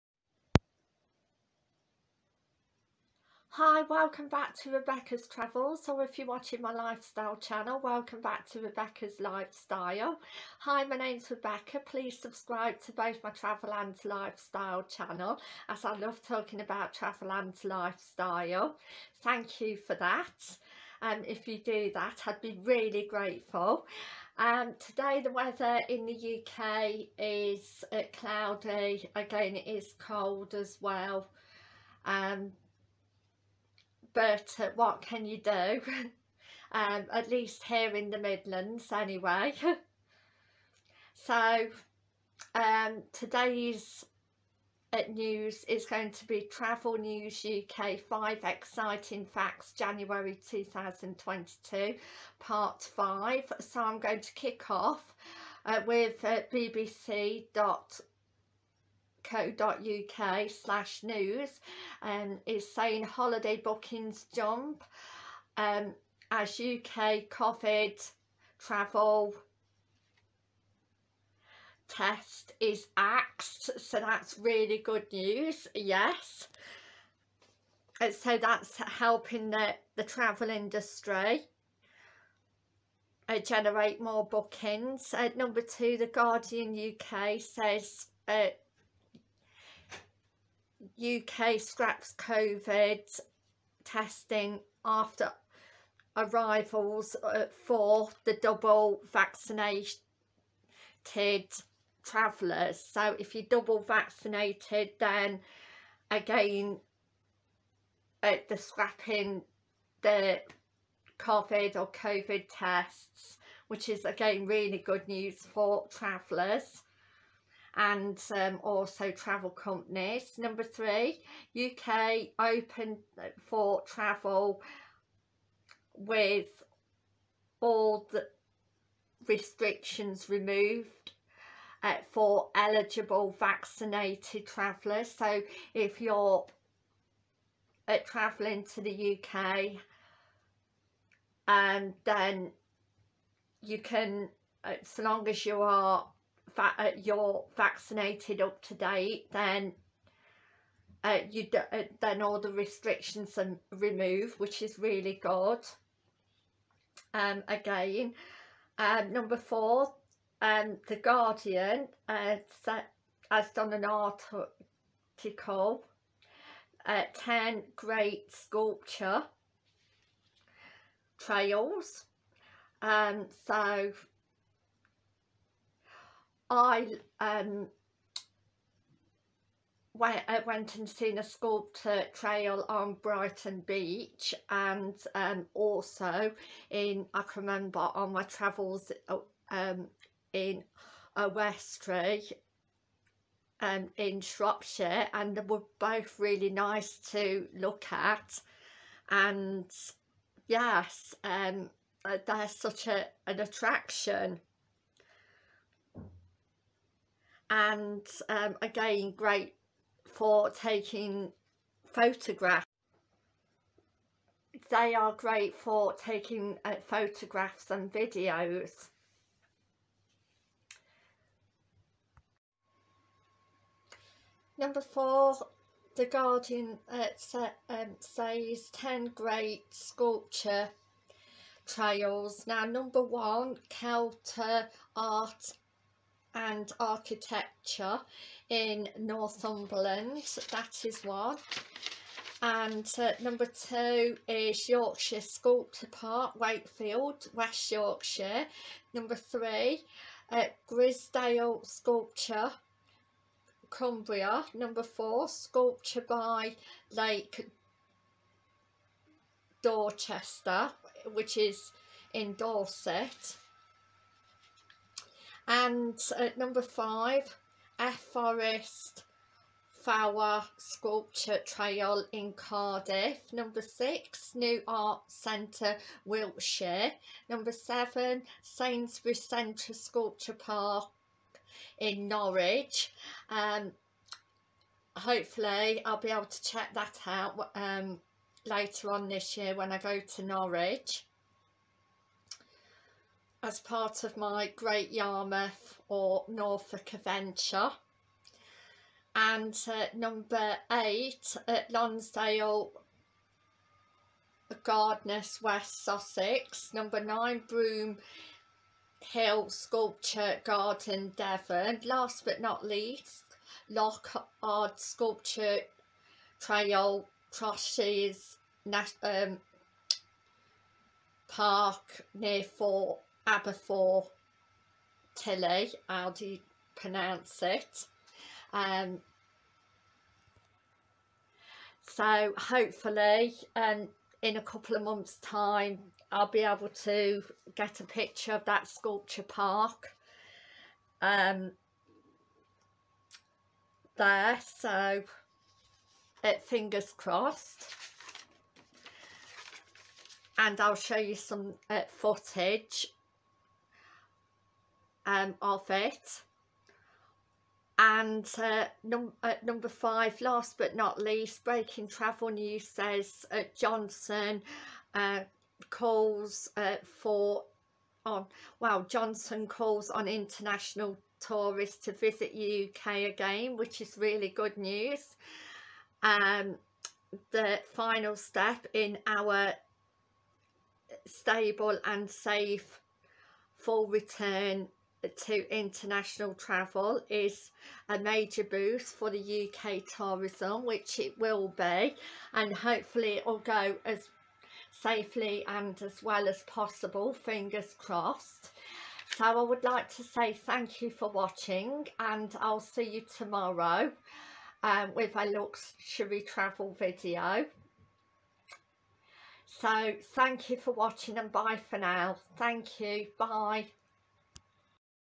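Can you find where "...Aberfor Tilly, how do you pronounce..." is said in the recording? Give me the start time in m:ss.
5:23.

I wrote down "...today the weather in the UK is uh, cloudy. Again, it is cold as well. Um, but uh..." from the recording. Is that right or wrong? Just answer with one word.
right.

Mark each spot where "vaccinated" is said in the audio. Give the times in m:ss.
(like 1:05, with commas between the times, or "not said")
1:39, 1:43, 2:13, 2:27.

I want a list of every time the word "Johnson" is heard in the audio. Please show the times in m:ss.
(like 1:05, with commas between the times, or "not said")
6:03, 6:08.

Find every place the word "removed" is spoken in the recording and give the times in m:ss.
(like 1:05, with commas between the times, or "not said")
2:10, 2:33.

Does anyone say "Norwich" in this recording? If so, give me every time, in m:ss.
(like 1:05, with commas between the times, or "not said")
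4:42, 4:50.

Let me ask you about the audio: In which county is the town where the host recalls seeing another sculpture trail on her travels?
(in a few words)
Shropshire.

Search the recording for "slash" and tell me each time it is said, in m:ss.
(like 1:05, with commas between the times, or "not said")
1:00.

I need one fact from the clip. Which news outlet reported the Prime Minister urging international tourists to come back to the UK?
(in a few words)
Breaking Travel News.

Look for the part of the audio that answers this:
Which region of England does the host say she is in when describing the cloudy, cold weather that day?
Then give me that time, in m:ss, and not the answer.
0:37.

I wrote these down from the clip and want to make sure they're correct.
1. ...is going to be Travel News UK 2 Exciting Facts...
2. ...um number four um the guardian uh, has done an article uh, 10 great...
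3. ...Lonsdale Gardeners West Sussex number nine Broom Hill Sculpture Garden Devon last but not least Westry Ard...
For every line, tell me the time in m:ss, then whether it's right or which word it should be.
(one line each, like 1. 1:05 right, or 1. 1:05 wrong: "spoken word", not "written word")
1. 0:45 wrong: "5", not "2"
2. 2:38 right
3. 5:01 wrong: "Loch", not "Westry".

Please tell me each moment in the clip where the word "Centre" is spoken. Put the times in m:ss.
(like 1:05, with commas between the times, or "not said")
4:35, 4:39.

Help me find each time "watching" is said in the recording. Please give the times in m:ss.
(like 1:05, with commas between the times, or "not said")
0:06, 6:41, 6:50.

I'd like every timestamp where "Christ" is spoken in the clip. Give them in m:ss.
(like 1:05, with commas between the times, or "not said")
not said.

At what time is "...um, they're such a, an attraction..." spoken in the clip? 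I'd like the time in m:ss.
3:21.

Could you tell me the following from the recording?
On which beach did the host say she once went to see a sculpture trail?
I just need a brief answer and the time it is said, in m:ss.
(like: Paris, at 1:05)
Brighton Beach, at 3:03.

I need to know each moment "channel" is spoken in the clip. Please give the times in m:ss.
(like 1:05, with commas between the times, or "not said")
0:07, 0:14.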